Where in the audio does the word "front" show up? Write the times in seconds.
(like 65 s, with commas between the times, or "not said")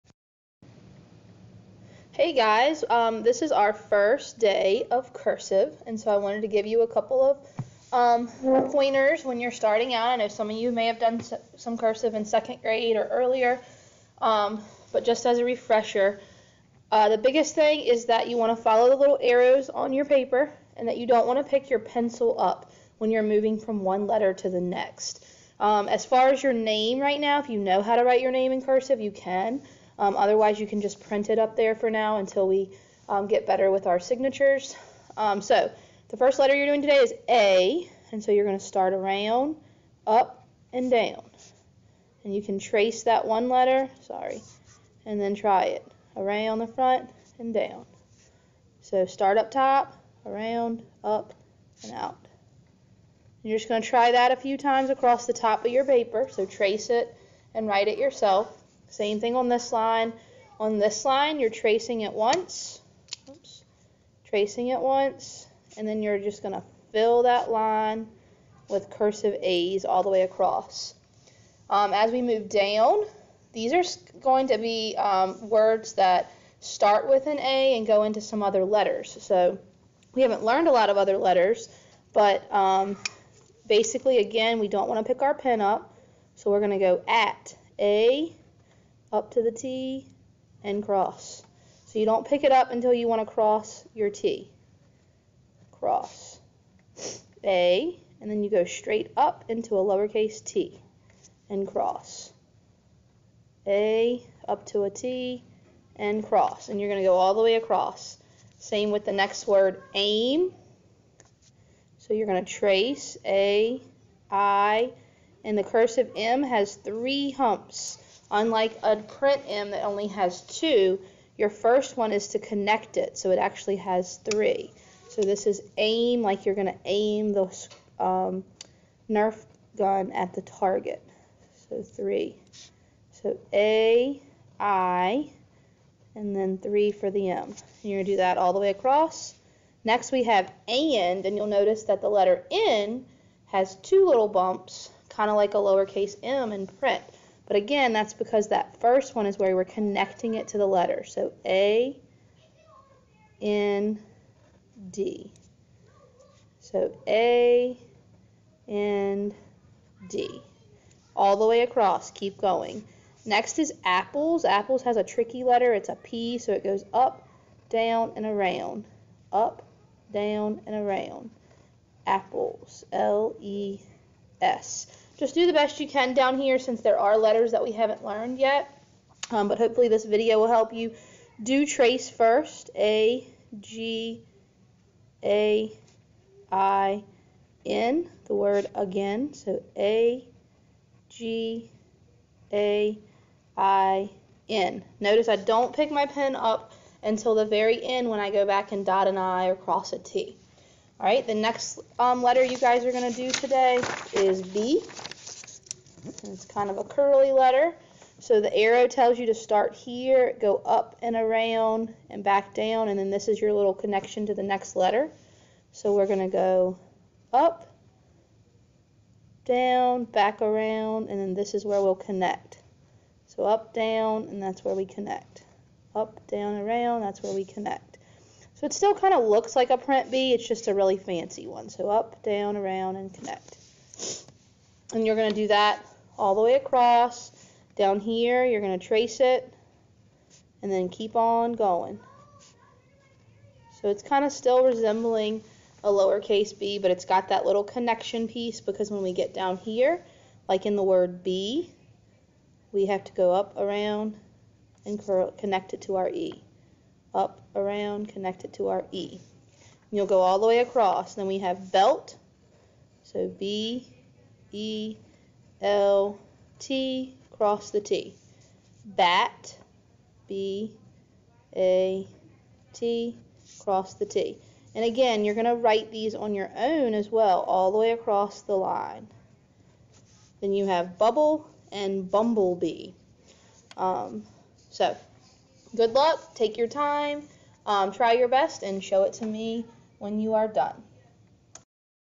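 46 s.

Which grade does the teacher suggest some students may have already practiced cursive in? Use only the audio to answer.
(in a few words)
second grade.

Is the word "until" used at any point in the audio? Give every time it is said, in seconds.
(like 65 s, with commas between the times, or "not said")
32 s, 92 s, 197 s.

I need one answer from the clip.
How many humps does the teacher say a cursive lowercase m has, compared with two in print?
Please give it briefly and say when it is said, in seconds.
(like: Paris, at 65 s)
3, at 116 s.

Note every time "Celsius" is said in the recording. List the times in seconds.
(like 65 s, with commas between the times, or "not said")
not said.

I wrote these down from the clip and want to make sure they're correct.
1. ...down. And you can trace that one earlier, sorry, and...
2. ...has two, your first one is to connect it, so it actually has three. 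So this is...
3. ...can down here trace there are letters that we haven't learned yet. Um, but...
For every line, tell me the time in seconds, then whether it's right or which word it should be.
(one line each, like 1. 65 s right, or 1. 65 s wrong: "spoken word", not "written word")
1. 40 s wrong: "letter", not "earlier"
2. 120 s right
3. 175 s wrong: "since", not "trace".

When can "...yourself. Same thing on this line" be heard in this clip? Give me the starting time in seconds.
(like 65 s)
57 s.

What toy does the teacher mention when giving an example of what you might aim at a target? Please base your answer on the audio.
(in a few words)
Nerf gun.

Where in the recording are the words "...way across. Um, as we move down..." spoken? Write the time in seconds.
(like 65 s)
70 s.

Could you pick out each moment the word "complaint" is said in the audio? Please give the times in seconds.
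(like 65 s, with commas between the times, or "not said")
not said.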